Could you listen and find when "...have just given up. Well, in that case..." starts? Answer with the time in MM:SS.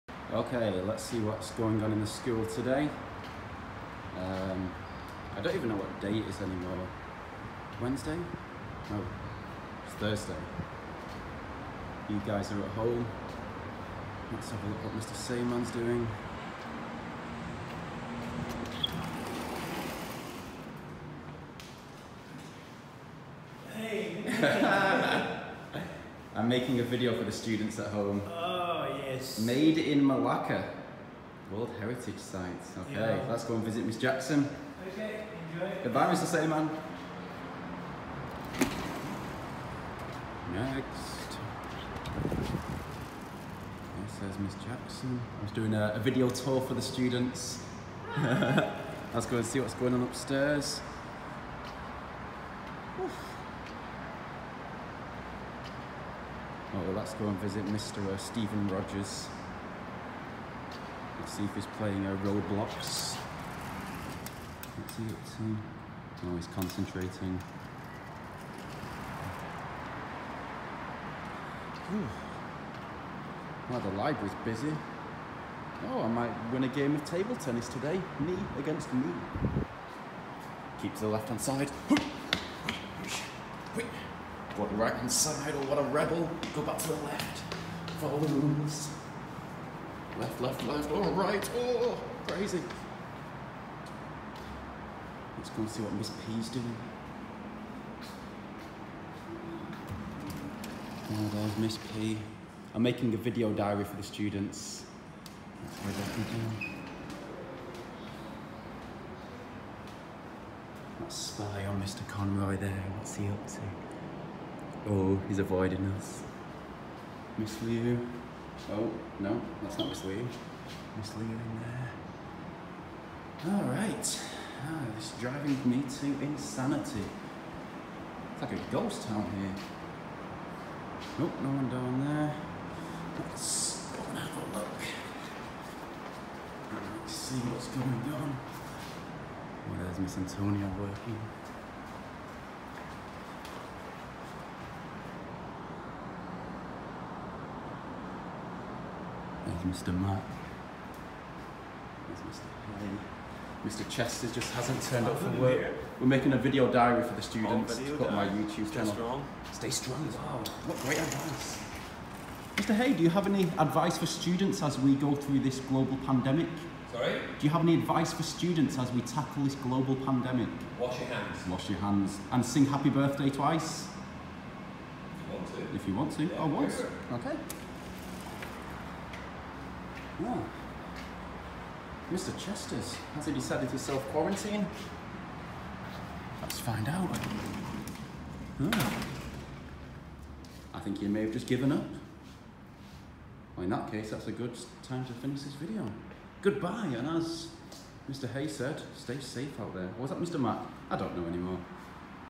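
03:11.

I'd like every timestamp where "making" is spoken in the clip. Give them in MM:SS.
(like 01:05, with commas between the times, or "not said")
00:26, 01:42, 02:36.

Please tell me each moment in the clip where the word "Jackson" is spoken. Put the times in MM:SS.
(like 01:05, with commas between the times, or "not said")
00:33, 00:44.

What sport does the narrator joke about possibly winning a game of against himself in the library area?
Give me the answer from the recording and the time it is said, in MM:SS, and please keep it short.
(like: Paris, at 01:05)
Table tennis, at 01:17.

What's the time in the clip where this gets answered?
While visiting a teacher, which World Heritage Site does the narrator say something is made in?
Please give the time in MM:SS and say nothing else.
00:30.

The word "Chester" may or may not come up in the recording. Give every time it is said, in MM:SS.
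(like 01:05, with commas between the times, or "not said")
02:33, 03:02.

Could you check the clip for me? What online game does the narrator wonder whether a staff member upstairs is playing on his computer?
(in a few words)
Roblox.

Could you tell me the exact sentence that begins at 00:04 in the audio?
Um, I don't even know what day it is anymore.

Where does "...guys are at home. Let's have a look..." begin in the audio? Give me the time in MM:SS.
00:12.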